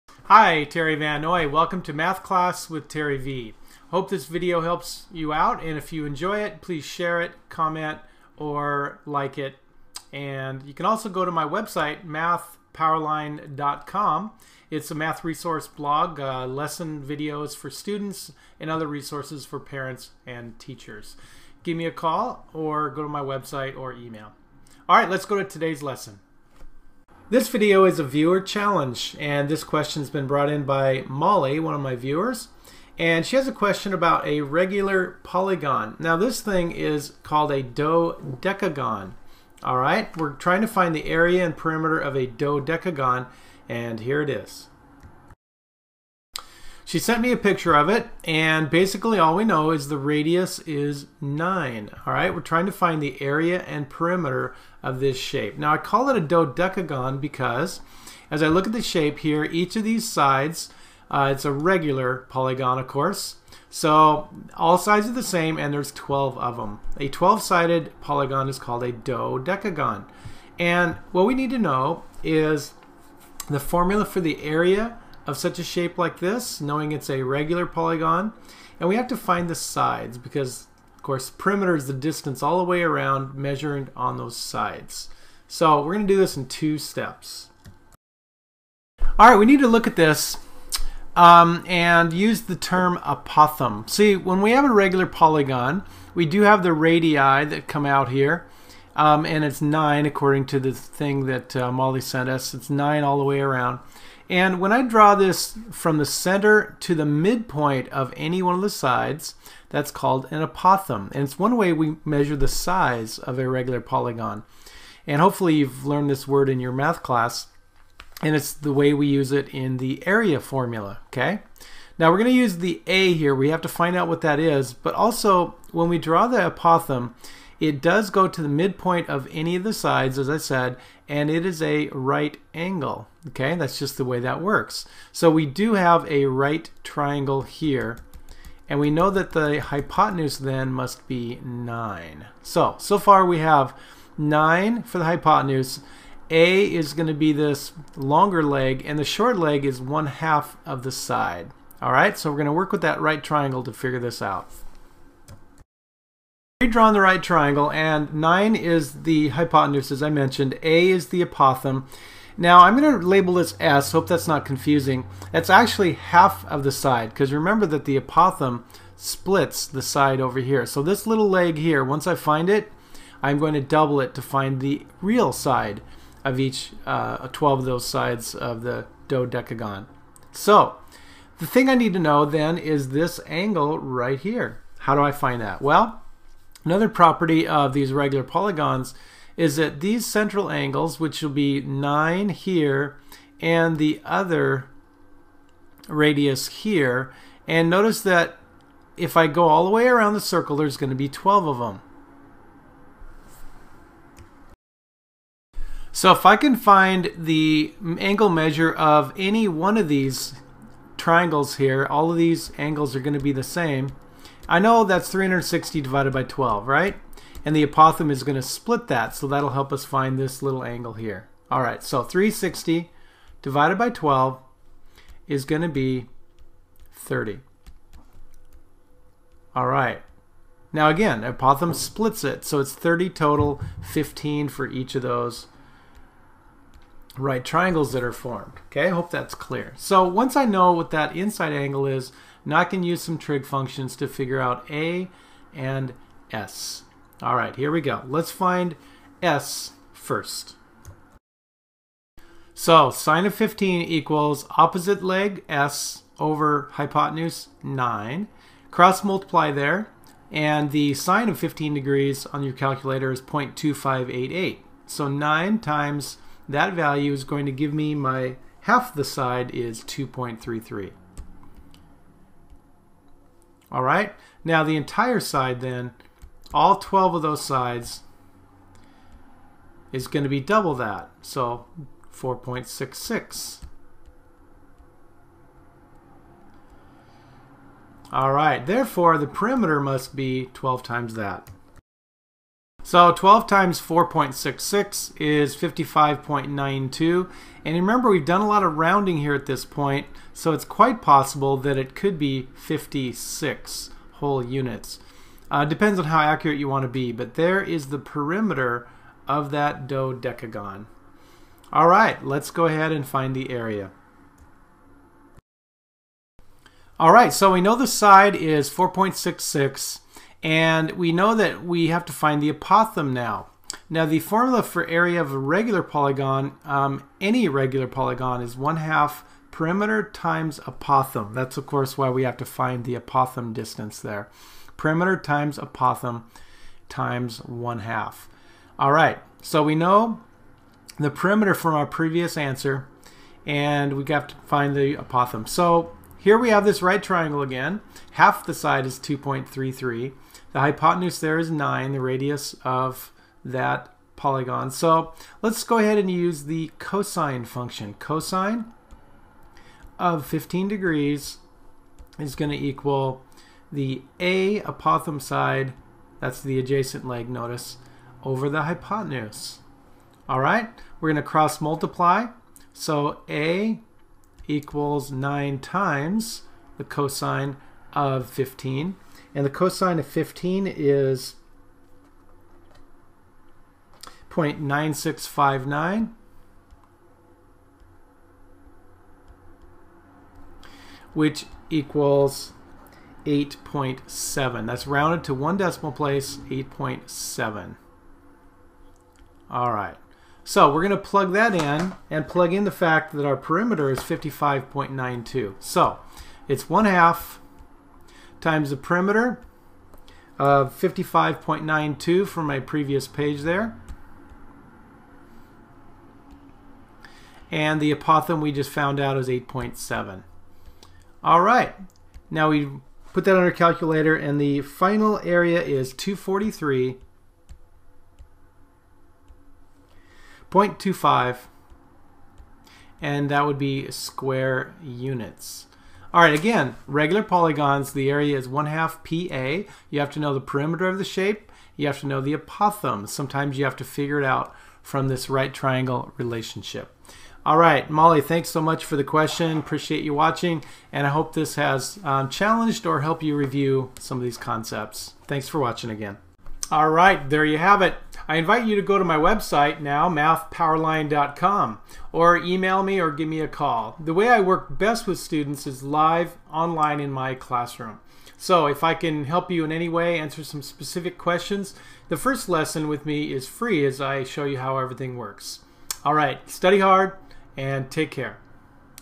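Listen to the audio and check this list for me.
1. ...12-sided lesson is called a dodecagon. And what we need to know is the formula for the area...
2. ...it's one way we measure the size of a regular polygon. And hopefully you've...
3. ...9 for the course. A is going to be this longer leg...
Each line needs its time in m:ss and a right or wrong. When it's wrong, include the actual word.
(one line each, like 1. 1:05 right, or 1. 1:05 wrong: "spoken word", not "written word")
1. 1:07 wrong: "polygon", not "lesson"
2. 1:51 right
3. 2:24 wrong: "hypotenuse", not "course".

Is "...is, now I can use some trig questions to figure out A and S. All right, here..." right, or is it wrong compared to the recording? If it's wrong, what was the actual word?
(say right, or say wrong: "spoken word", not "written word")
wrong: "functions", not "questions".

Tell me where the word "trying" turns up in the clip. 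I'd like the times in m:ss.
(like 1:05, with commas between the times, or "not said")
0:40, 0:52.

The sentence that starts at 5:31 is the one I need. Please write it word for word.
That's of course why we have to find the apothem distance there.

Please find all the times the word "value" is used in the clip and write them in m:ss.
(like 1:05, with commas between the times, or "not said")
4:26.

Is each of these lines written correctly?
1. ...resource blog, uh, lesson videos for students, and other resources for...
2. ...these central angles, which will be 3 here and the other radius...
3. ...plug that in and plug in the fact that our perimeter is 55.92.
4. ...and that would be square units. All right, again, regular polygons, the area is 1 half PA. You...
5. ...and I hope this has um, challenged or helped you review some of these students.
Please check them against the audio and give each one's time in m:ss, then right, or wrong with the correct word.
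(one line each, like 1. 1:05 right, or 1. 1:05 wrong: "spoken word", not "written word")
1. 0:15 right
2. 3:09 wrong: "9", not "3"
3. 6:40 right
4. 7:13 right
5. 7:30 wrong: "concepts", not "students".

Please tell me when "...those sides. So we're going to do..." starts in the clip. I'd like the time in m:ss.
1:24.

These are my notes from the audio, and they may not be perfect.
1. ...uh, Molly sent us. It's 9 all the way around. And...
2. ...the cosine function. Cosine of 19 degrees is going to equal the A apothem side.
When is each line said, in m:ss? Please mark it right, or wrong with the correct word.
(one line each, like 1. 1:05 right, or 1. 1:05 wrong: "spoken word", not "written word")
1. 1:41 right
2. 5:56 wrong: "15", not "19".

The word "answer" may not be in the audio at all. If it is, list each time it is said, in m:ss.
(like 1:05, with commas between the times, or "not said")
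5:42, 7:50.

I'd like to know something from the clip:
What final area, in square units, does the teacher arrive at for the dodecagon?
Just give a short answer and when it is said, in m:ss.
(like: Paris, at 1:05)
243.25, at 7:05.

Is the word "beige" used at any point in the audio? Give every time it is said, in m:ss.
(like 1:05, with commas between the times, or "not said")
not said.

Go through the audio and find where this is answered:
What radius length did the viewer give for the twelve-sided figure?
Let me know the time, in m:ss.
0:49.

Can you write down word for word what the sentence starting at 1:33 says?
See, when we have a regular polygon, we do have the radii that come out here.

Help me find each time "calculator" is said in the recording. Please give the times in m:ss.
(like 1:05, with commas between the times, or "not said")
4:22, 7:03.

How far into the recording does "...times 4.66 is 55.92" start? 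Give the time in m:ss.
4:53.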